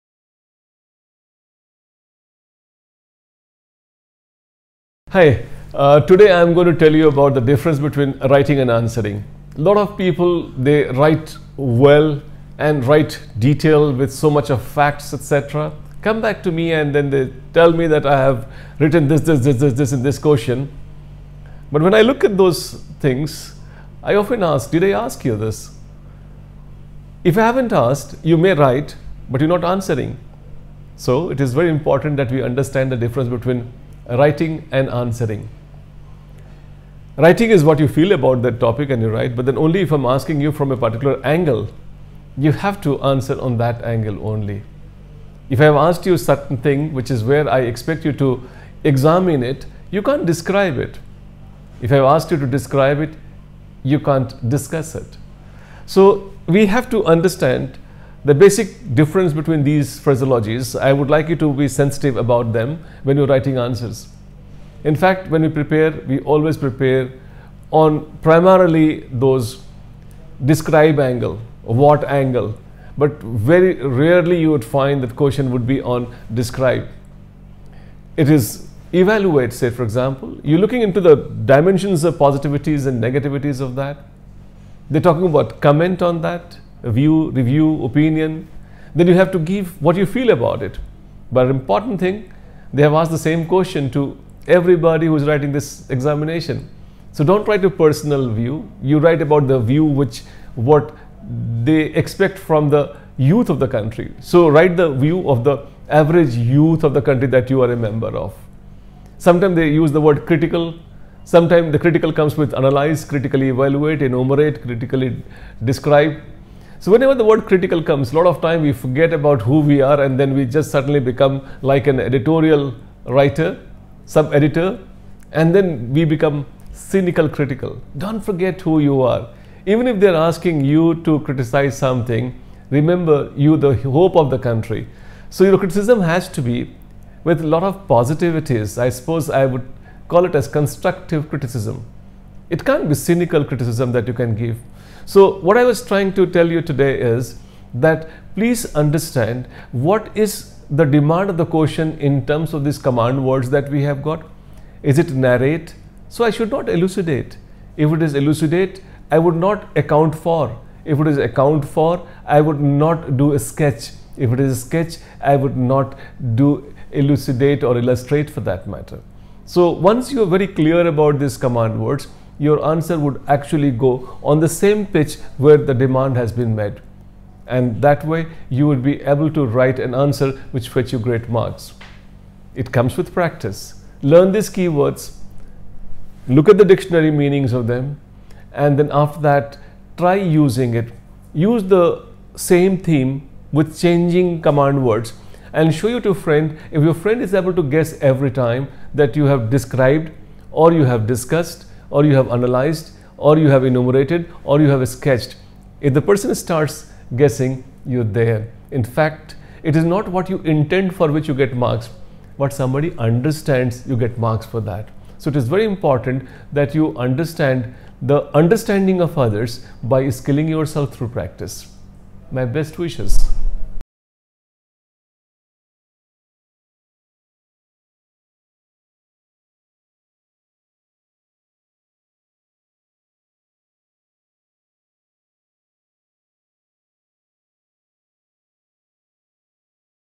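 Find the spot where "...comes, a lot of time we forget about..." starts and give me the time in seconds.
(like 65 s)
117 s.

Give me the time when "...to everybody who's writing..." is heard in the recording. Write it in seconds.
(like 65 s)
93 s.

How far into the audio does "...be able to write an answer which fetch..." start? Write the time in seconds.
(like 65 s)
178 s.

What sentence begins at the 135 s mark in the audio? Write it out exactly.
So your criticism has to be with a lot of positivities.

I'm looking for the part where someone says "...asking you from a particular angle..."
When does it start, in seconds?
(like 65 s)
40 s.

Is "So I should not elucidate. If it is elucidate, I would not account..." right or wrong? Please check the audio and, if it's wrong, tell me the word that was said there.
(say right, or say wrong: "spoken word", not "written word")
right.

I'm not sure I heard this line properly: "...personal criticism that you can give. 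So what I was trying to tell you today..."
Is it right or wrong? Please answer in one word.
wrong.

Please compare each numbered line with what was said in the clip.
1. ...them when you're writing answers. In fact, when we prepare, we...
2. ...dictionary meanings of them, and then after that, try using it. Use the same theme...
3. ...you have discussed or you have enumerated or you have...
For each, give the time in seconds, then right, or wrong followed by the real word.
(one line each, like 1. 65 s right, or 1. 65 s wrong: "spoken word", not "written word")
1. 62 s right
2. 186 s right
3. 202 s wrong: "analyzed", not "discussed".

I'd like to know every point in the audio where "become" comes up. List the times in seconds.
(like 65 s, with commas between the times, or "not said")
120 s, 126 s.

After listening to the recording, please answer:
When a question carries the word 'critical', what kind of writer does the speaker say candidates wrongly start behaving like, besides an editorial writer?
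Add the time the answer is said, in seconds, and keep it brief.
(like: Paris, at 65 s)
Sub-editor, at 124 s.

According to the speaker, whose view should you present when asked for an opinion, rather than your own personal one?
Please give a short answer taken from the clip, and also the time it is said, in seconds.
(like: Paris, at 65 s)
The average youth, at 105 s.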